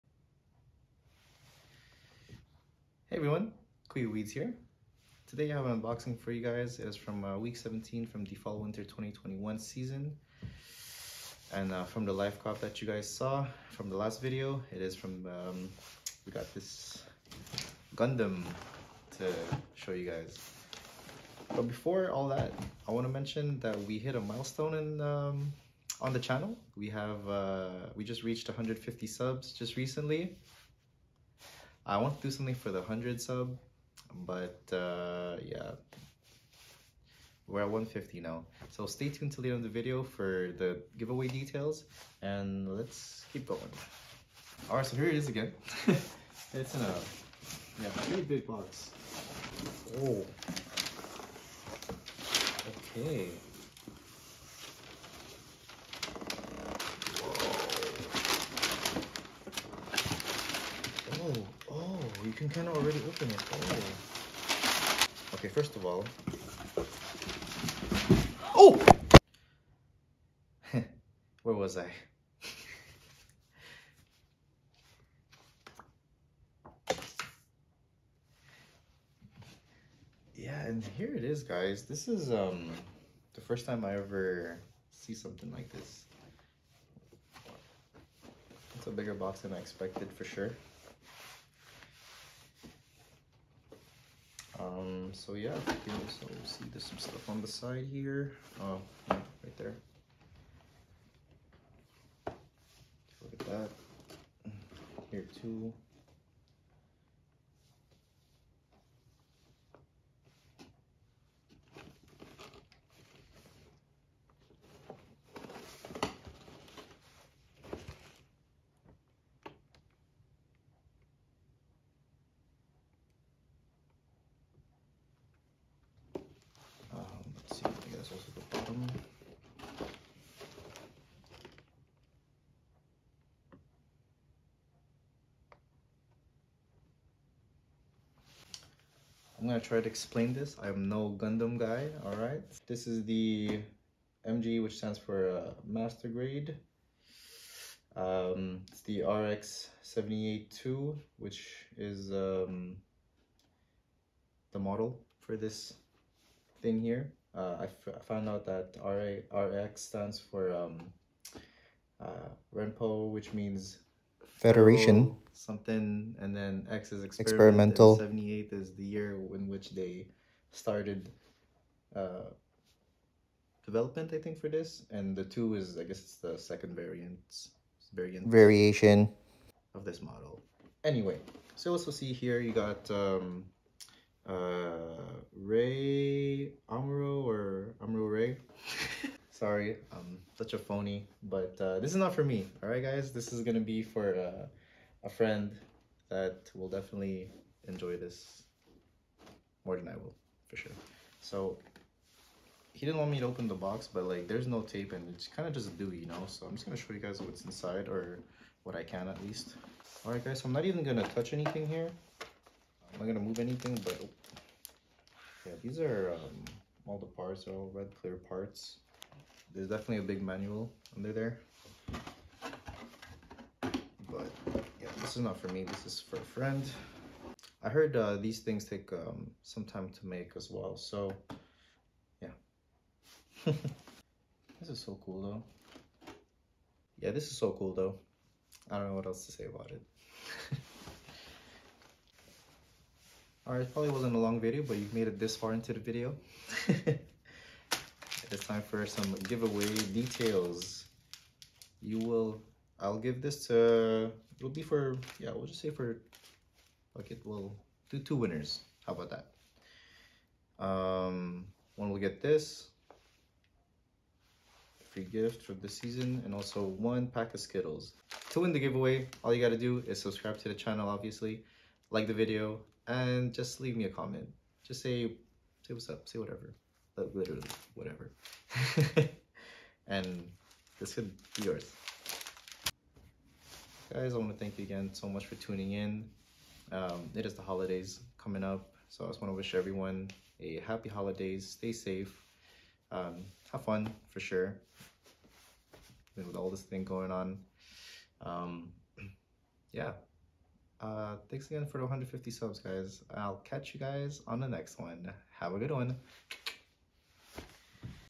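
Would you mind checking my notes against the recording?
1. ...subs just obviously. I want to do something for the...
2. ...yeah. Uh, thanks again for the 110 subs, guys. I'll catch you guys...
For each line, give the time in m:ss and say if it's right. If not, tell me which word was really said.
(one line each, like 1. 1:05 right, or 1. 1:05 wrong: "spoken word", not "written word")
1. 0:29 wrong: "recently", not "obviously"
2. 4:59 wrong: "150", not "110".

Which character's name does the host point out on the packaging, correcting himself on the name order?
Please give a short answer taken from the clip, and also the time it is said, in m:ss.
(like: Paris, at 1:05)
Amuro Ray, at 3:07.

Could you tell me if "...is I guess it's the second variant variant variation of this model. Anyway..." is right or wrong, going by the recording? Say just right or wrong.
right.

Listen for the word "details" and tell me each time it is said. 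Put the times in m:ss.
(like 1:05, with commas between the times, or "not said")
0:41, 4:09.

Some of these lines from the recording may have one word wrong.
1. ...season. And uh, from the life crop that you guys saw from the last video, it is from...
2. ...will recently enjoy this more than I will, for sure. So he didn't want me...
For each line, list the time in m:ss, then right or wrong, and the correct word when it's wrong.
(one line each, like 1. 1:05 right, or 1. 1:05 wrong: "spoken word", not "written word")
1. 0:09 right
2. 3:16 wrong: "definitely", not "recently".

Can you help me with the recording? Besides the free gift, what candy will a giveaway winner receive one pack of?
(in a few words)
Skittles.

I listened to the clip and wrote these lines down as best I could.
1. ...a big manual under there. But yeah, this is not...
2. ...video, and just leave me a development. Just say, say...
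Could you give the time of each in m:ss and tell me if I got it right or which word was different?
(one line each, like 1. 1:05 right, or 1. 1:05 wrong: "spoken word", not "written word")
1. 3:39 right
2. 4:32 wrong: "comment", not "development".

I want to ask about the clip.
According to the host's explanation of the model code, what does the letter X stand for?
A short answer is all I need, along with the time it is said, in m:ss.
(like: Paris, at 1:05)
Experimental, at 2:47.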